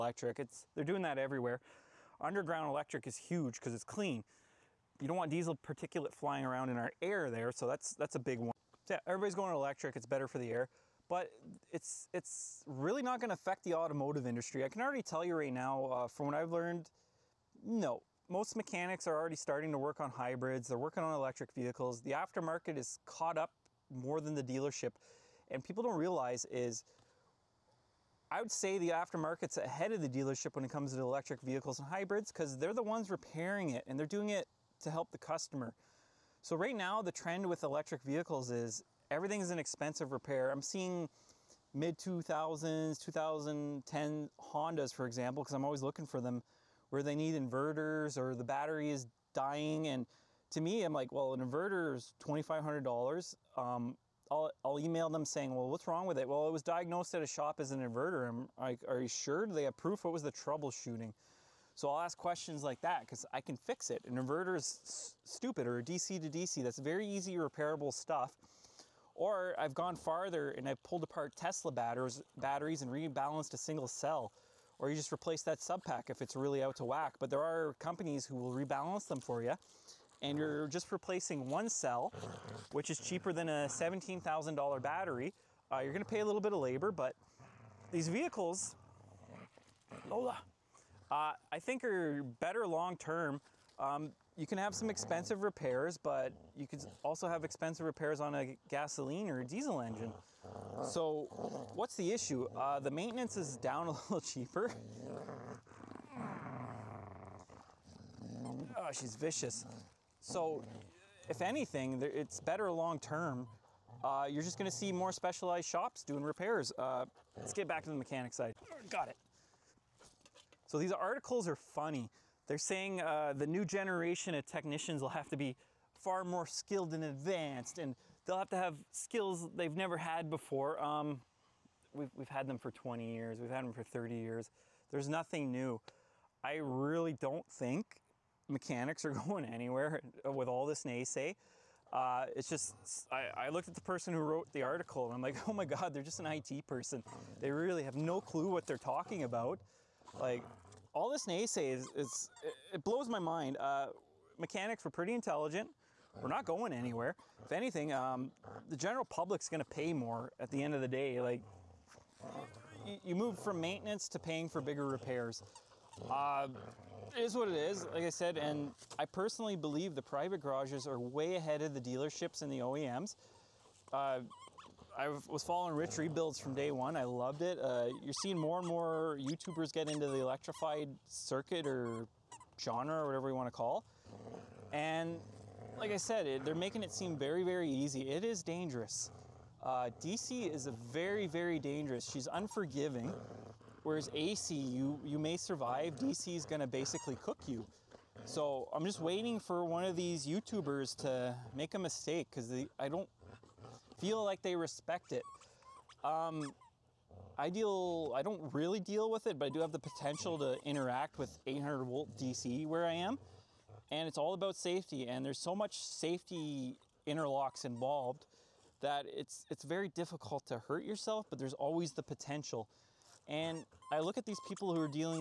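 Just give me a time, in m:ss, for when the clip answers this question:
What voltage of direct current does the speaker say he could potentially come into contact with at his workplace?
3:31.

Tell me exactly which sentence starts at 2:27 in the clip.
They really have no clue what they're talking about.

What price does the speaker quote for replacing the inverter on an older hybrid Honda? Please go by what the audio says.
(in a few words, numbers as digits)
$2,500.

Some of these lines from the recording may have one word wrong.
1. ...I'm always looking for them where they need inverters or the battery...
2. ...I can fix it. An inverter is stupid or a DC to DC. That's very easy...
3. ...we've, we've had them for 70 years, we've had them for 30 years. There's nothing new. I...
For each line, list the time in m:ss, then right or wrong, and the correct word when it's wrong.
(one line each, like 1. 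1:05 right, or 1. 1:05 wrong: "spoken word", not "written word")
1. 0:45 right
2. 1:03 right
3. 2:11 wrong: "20", not "70".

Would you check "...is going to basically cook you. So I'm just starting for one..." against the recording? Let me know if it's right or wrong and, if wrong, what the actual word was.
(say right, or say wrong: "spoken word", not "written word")
wrong: "waiting", not "starting".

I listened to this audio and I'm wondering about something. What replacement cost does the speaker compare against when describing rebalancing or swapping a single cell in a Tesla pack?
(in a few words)
$17,000.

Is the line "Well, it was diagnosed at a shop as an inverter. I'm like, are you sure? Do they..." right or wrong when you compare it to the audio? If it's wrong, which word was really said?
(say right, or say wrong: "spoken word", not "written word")
right.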